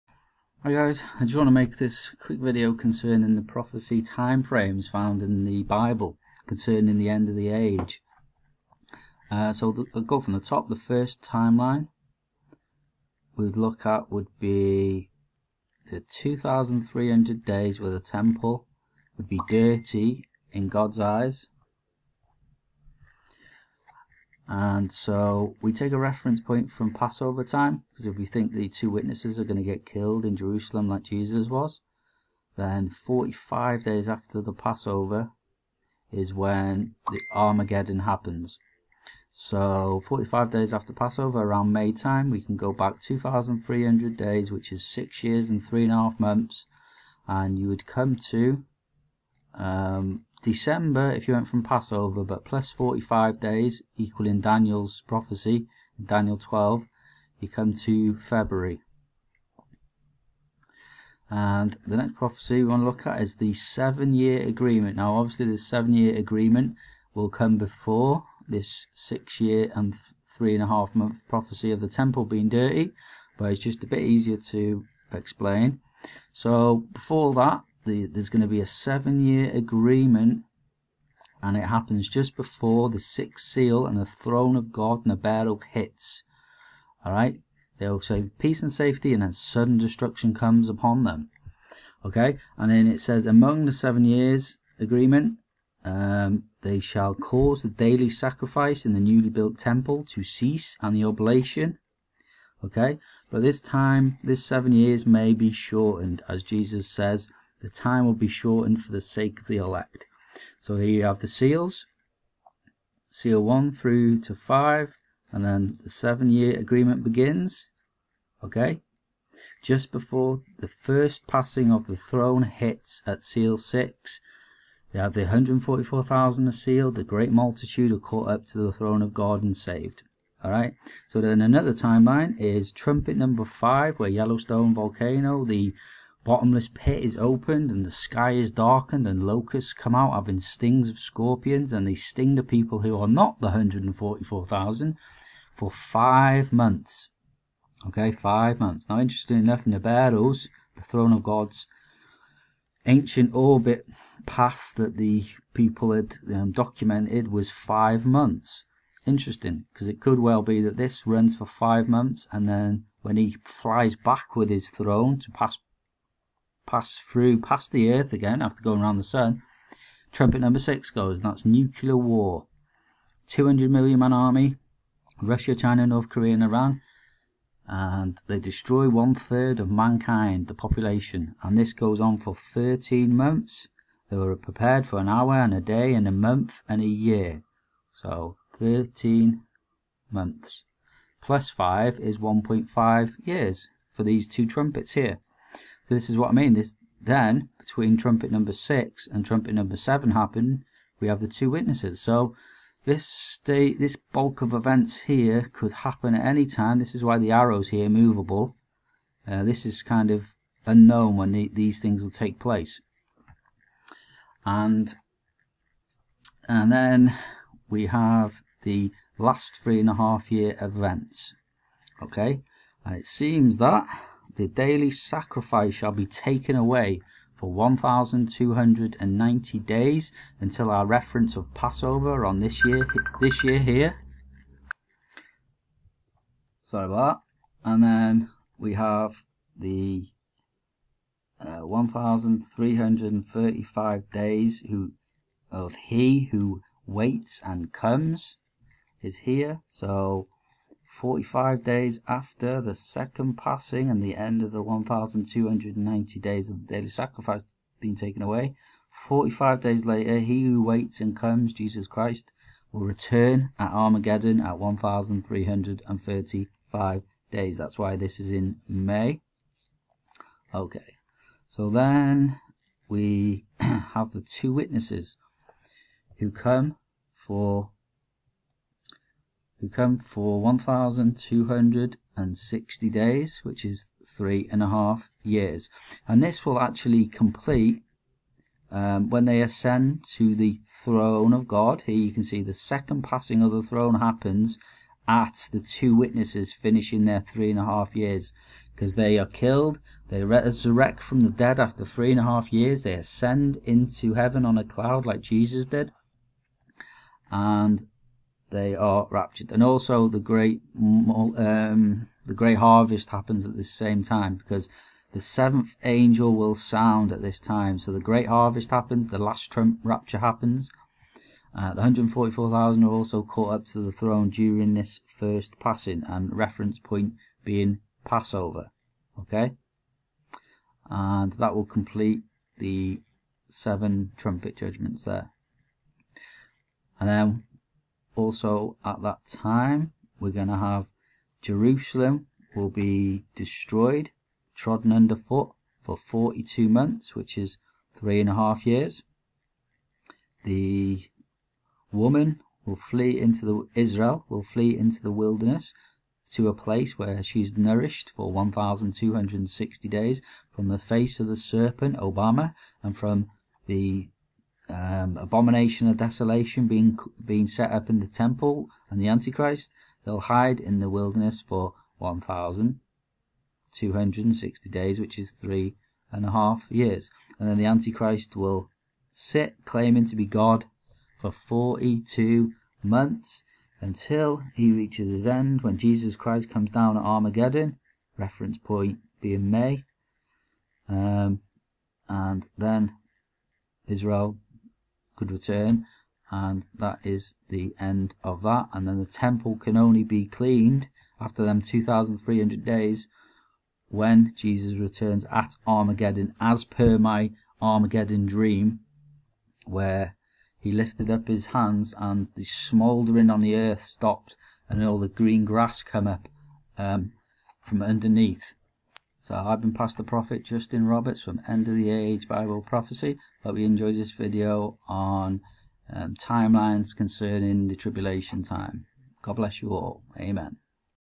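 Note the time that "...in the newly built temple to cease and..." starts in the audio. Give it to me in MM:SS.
01:38.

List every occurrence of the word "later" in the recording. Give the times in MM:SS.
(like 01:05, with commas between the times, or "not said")
04:19.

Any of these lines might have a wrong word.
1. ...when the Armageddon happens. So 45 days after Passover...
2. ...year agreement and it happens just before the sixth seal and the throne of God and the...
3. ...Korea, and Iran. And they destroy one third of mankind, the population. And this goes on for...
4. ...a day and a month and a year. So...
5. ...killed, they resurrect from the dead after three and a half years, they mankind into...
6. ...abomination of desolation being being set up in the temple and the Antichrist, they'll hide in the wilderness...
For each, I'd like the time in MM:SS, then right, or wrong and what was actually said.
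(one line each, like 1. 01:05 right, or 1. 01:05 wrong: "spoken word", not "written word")
1. 00:36 right
2. 01:19 right
3. 02:56 right
4. 03:05 right
5. 04:59 wrong: "ascend", not "mankind"
6. 06:05 right.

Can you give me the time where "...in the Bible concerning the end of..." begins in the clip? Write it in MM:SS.
00:05.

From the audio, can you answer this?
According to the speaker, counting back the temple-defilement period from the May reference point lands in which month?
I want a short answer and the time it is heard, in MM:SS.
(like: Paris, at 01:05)
February, at 00:58.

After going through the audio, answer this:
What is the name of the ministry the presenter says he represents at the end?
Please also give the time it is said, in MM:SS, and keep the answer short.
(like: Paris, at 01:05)
End of the Age Bible Prophecy, at 07:01.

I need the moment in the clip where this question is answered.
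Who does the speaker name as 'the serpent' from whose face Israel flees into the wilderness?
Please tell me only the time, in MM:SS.
06:01.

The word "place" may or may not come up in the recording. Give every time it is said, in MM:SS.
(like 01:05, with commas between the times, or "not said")
03:32, 05:56.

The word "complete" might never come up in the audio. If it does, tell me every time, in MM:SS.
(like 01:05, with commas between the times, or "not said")
04:47, 05:31.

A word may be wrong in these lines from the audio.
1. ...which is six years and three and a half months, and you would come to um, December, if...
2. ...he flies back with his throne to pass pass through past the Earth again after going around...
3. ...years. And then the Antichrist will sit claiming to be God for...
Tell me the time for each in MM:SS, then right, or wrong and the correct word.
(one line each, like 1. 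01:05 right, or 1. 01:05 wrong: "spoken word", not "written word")
1. 00:44 right
2. 02:43 right
3. 06:16 right.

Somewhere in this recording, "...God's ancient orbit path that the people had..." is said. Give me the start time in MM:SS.
02:31.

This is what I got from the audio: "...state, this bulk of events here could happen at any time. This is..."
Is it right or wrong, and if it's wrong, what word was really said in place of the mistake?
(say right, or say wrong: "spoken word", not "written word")
right.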